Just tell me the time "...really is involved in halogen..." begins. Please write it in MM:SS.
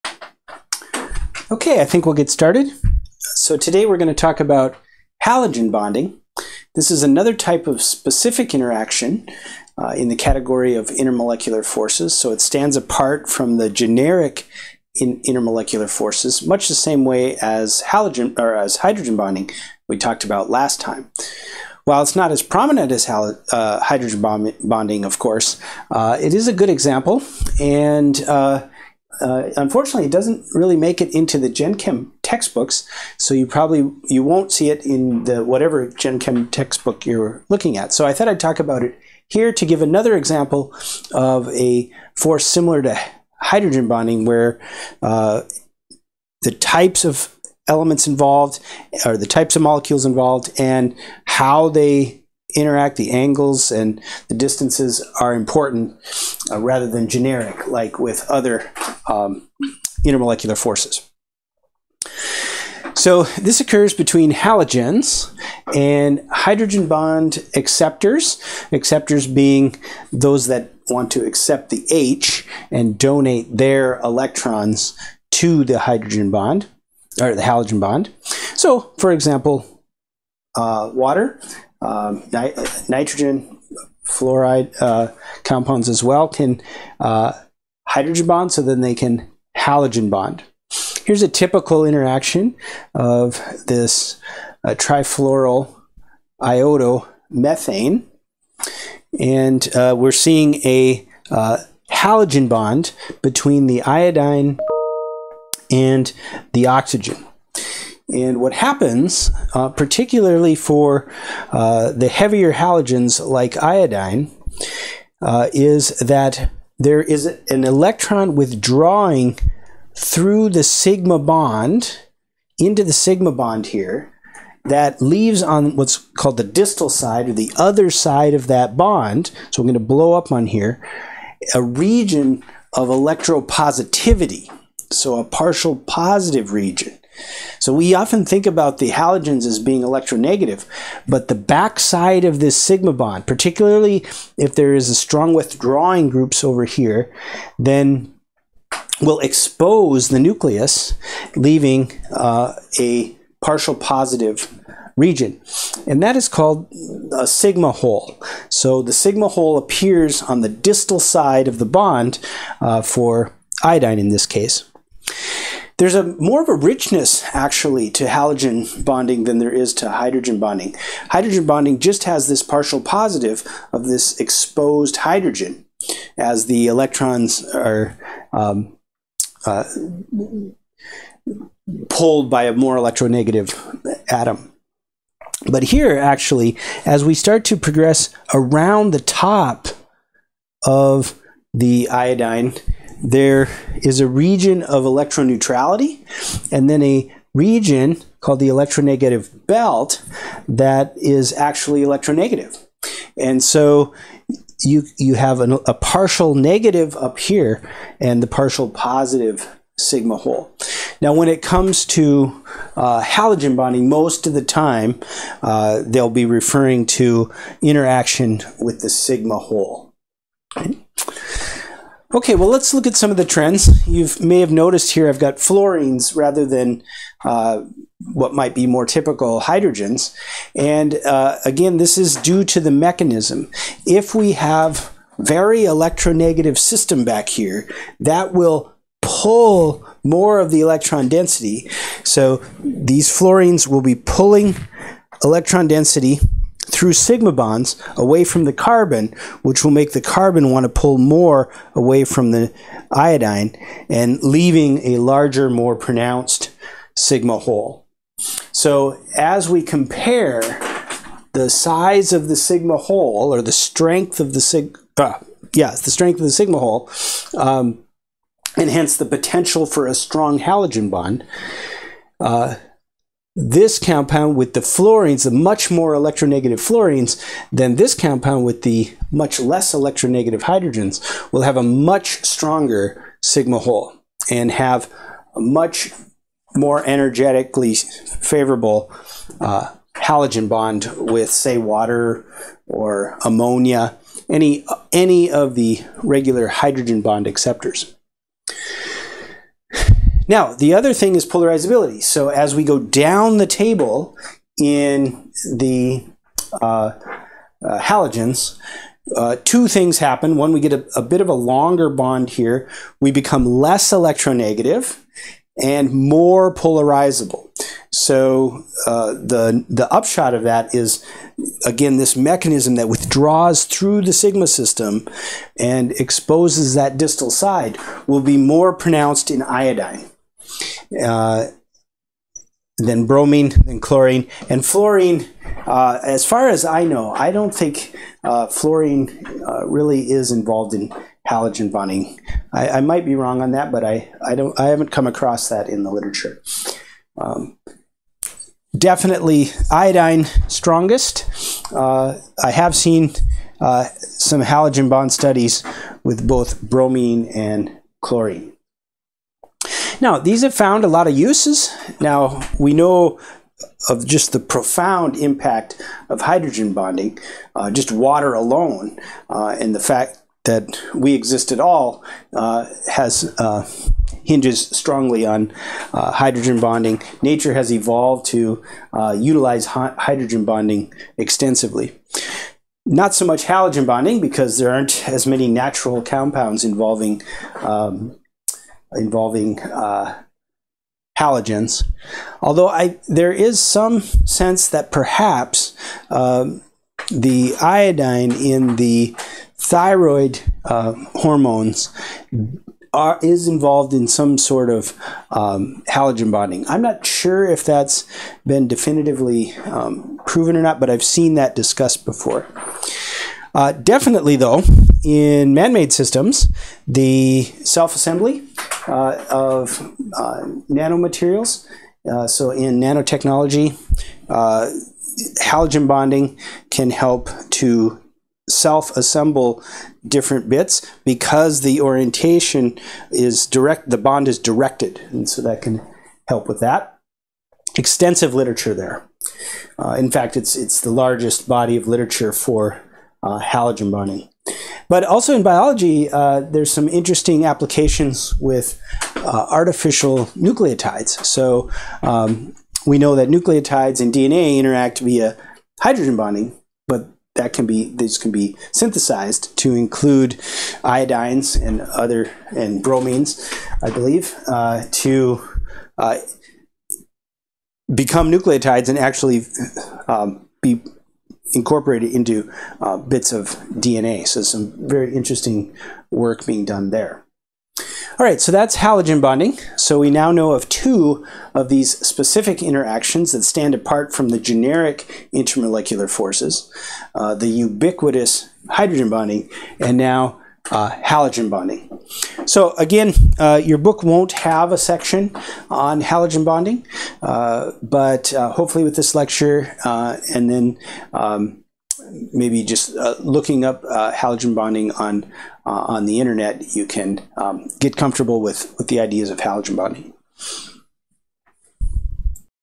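05:39.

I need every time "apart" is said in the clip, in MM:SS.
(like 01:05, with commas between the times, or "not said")
00:12, 08:03.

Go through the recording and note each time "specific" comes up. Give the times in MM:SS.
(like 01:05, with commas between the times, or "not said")
00:07, 08:02.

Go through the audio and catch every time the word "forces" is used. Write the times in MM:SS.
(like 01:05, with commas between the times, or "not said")
00:11, 00:15, 00:42, 01:00, 08:06.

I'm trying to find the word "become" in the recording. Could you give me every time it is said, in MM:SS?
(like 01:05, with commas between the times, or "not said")
05:13, 07:47.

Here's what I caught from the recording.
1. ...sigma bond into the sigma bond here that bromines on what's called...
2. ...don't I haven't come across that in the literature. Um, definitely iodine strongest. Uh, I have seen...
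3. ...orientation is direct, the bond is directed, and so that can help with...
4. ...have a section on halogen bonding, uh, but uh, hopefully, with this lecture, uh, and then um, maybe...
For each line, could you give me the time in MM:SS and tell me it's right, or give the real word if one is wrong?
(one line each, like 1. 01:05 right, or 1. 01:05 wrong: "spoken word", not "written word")
1. 02:00 wrong: "leaves", not "bromines"
2. 05:44 right
3. 07:11 right
4. 08:14 right.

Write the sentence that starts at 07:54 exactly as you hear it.
So some very interesting work being done there.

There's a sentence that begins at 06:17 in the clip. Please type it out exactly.
Nature has evolved to uh, utilize hydrogen bonding extensively.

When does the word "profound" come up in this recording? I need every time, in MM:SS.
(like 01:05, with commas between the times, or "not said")
06:04.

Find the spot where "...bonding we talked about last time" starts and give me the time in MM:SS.
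00:19.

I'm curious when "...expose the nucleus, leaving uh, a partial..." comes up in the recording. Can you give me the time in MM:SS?
02:29.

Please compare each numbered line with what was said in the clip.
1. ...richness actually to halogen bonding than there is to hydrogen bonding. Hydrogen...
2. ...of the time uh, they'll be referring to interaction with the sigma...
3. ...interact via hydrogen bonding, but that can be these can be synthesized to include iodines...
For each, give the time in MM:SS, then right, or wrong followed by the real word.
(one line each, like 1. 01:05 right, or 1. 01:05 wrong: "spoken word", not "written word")
1. 02:46 right
2. 03:34 right
3. 07:34 right.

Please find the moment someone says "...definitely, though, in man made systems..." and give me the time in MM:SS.
06:53.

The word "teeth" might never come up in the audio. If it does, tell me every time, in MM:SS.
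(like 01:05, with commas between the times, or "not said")
not said.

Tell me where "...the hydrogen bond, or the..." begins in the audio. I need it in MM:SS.
01:15.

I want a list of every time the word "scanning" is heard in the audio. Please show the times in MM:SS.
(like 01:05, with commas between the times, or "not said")
not said.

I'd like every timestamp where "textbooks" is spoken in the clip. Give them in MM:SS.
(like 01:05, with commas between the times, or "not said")
00:32, 00:36.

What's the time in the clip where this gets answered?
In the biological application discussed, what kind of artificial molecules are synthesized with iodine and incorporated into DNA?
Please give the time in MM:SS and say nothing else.
07:29.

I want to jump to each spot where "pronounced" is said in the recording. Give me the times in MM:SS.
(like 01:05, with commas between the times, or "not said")
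04:15, 05:28.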